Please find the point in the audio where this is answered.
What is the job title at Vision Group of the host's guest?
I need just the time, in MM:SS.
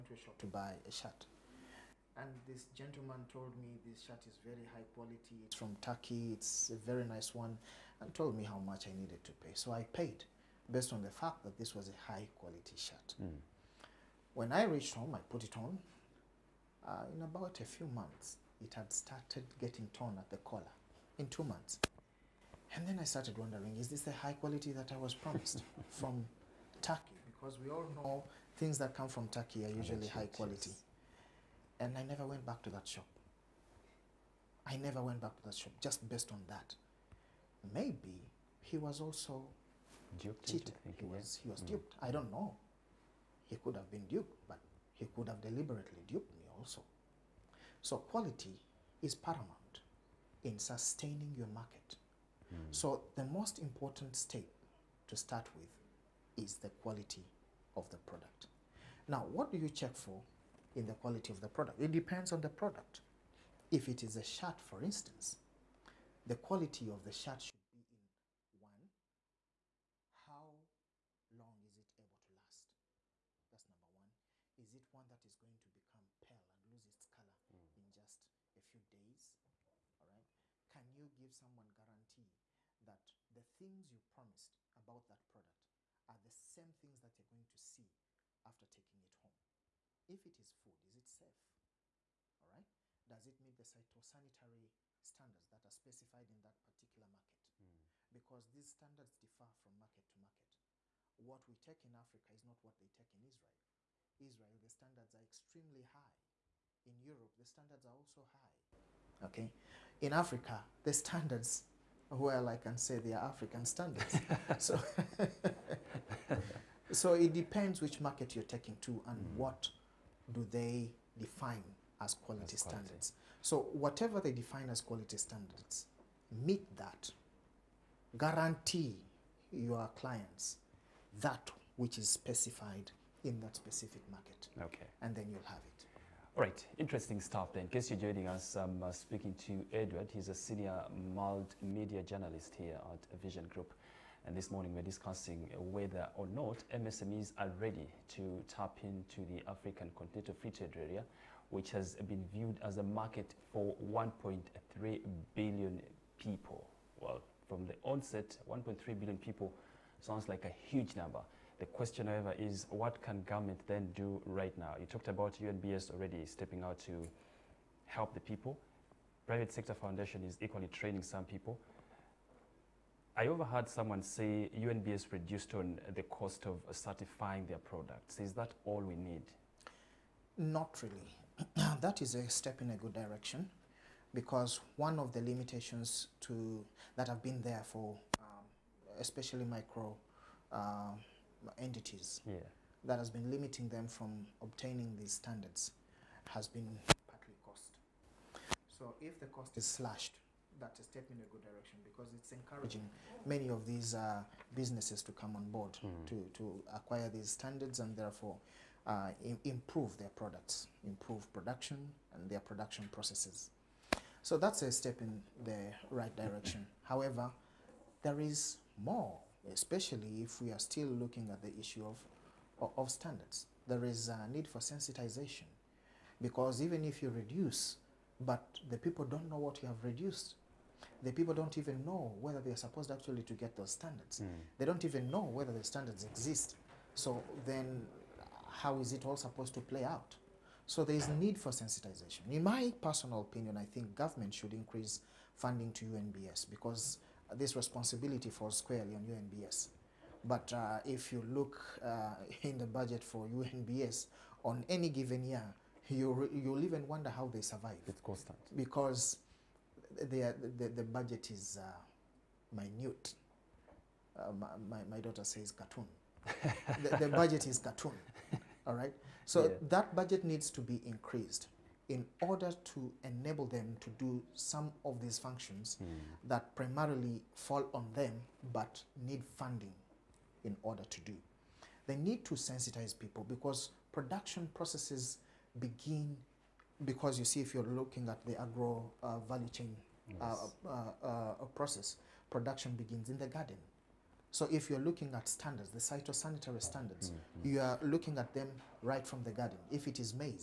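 02:20.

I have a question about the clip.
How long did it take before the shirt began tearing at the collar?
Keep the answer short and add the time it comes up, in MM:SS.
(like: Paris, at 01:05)
2 months, at 00:21.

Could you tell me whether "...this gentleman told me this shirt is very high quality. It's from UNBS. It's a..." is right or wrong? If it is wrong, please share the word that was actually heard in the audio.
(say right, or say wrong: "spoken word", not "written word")
wrong: "Turkey", not "UNBS".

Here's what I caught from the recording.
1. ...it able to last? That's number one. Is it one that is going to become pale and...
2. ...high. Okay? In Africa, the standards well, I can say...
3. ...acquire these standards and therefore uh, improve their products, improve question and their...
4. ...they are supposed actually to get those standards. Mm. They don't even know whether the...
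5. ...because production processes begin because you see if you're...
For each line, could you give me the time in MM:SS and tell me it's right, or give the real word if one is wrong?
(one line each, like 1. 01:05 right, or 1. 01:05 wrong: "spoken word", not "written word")
1. 01:11 right
2. 01:48 right
3. 03:26 wrong: "production", not "question"
4. 03:52 right
5. 04:43 right.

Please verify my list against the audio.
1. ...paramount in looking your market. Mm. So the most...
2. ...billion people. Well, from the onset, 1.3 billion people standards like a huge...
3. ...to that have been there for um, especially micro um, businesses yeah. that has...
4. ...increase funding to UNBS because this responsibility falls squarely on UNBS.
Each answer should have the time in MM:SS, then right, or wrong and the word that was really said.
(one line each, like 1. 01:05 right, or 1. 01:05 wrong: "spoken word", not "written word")
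1. 00:49 wrong: "sustaining", not "looking"
2. 02:35 wrong: "sounds", not "standards"
3. 03:06 wrong: "entities", not "businesses"
4. 04:04 right.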